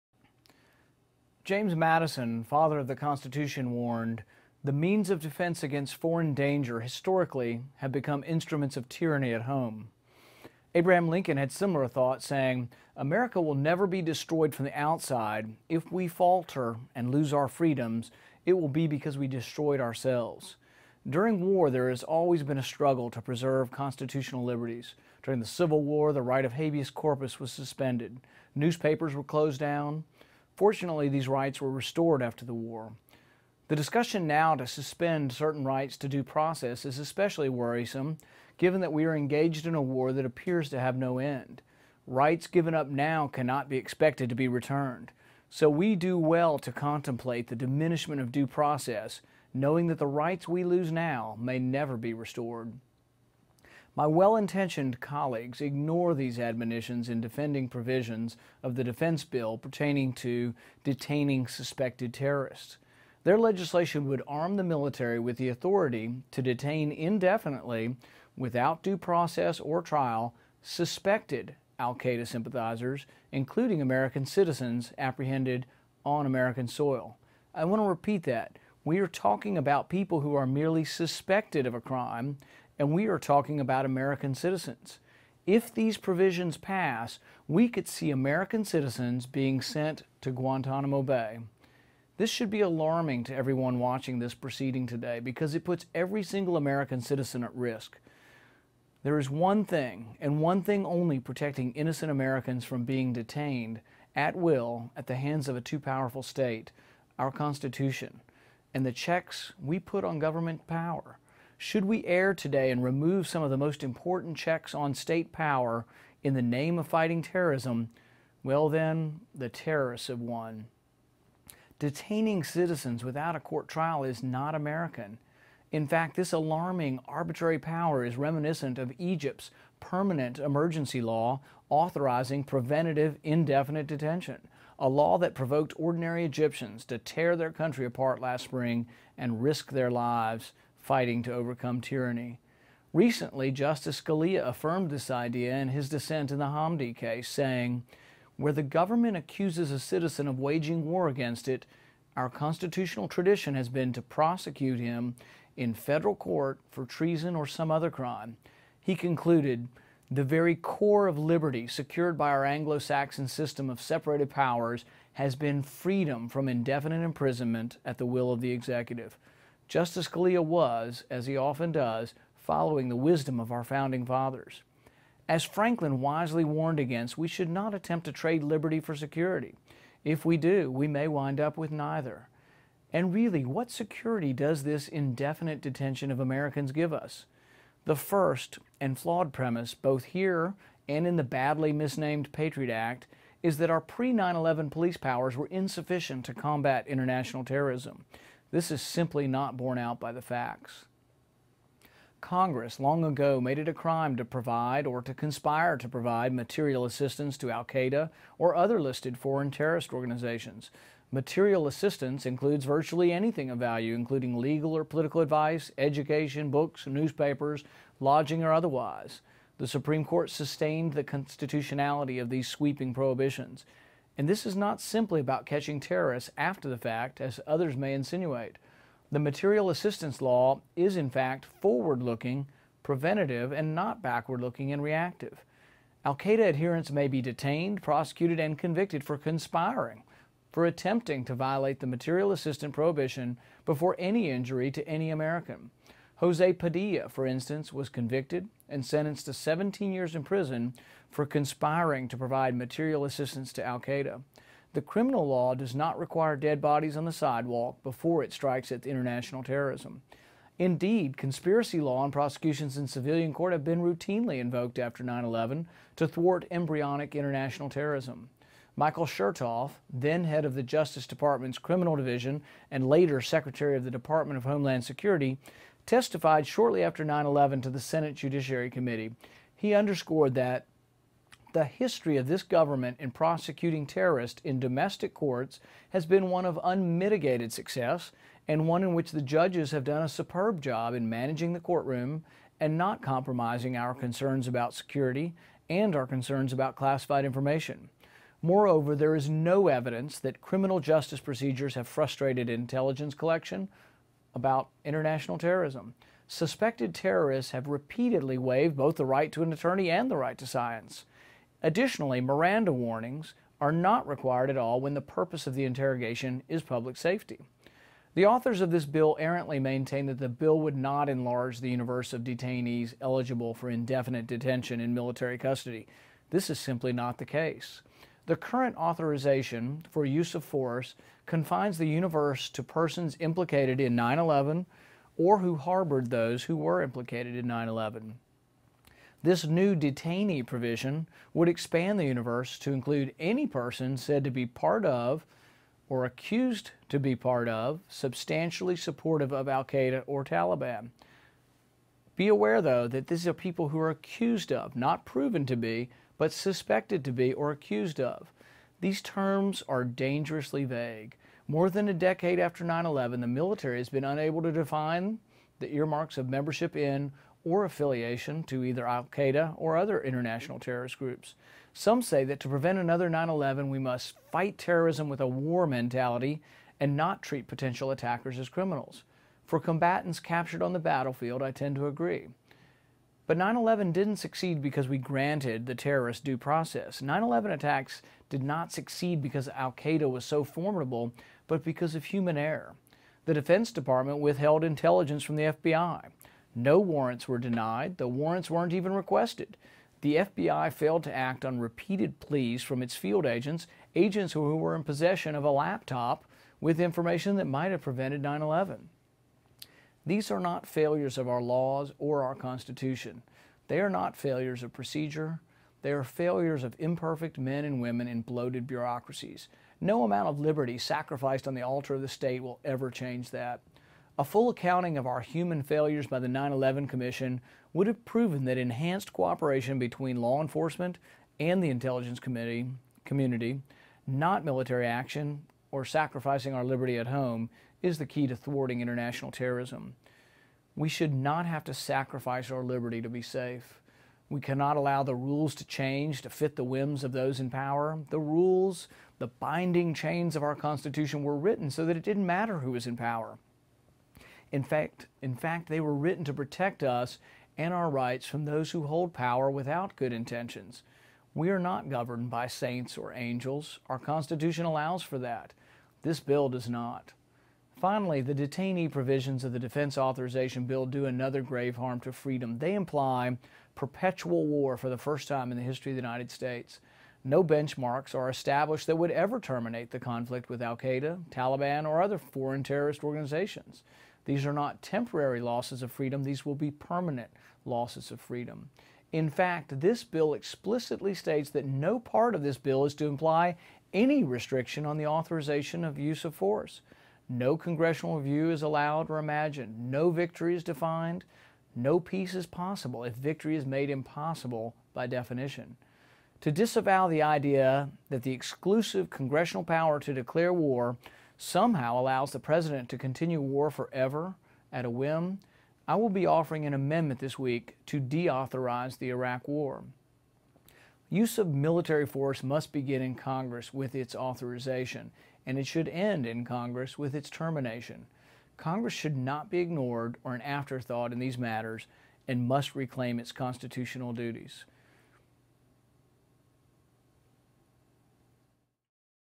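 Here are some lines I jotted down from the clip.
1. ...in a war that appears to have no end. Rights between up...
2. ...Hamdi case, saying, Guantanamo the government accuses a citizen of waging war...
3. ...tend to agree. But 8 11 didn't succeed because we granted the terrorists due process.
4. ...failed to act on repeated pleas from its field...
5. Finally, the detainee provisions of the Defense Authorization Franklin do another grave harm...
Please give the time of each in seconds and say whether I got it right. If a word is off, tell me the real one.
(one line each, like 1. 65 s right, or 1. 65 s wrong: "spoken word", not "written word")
1. 39 s wrong: "given", not "between"
2. 146 s wrong: "Where", not "Guantanamo"
3. 381 s wrong: "9", not "8"
4. 400 s right
5. 467 s wrong: "Bill", not "Franklin".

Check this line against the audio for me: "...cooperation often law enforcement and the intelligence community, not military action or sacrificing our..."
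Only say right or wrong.
wrong.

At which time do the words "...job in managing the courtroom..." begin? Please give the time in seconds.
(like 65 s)
290 s.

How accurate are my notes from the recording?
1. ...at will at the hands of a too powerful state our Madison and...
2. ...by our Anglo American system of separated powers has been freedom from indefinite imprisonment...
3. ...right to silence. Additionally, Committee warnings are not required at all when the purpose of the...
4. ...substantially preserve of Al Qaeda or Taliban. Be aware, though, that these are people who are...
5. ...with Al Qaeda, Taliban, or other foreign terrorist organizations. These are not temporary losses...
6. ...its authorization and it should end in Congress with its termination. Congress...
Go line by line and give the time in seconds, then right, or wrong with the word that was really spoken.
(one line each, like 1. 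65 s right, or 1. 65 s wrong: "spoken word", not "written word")
1. 104 s wrong: "Constitution", not "Madison"
2. 162 s wrong: "Saxon", not "American"
3. 310 s wrong: "Miranda", not "Committee"
4. 347 s wrong: "supportive", not "preserve"
5. 480 s right
6. 523 s right.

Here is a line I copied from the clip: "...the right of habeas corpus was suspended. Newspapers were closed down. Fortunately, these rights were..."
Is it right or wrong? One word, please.
right.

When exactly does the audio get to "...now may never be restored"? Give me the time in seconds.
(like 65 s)
50 s.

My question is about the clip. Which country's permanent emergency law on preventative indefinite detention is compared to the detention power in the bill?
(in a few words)
Egypt.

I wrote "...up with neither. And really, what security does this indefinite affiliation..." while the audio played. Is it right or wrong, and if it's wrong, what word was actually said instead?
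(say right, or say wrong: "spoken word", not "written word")
wrong: "detention", not "affiliation".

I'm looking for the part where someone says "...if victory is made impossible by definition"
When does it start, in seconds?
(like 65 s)
503 s.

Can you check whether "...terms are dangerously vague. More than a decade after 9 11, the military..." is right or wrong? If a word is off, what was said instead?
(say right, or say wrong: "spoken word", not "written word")
right.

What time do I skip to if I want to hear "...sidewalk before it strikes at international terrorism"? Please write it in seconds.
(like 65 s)
257 s.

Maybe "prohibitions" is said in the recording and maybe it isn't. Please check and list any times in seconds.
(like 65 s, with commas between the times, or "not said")
222 s, 242 s.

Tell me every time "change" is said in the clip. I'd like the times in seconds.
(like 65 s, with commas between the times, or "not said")
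422 s, 445 s.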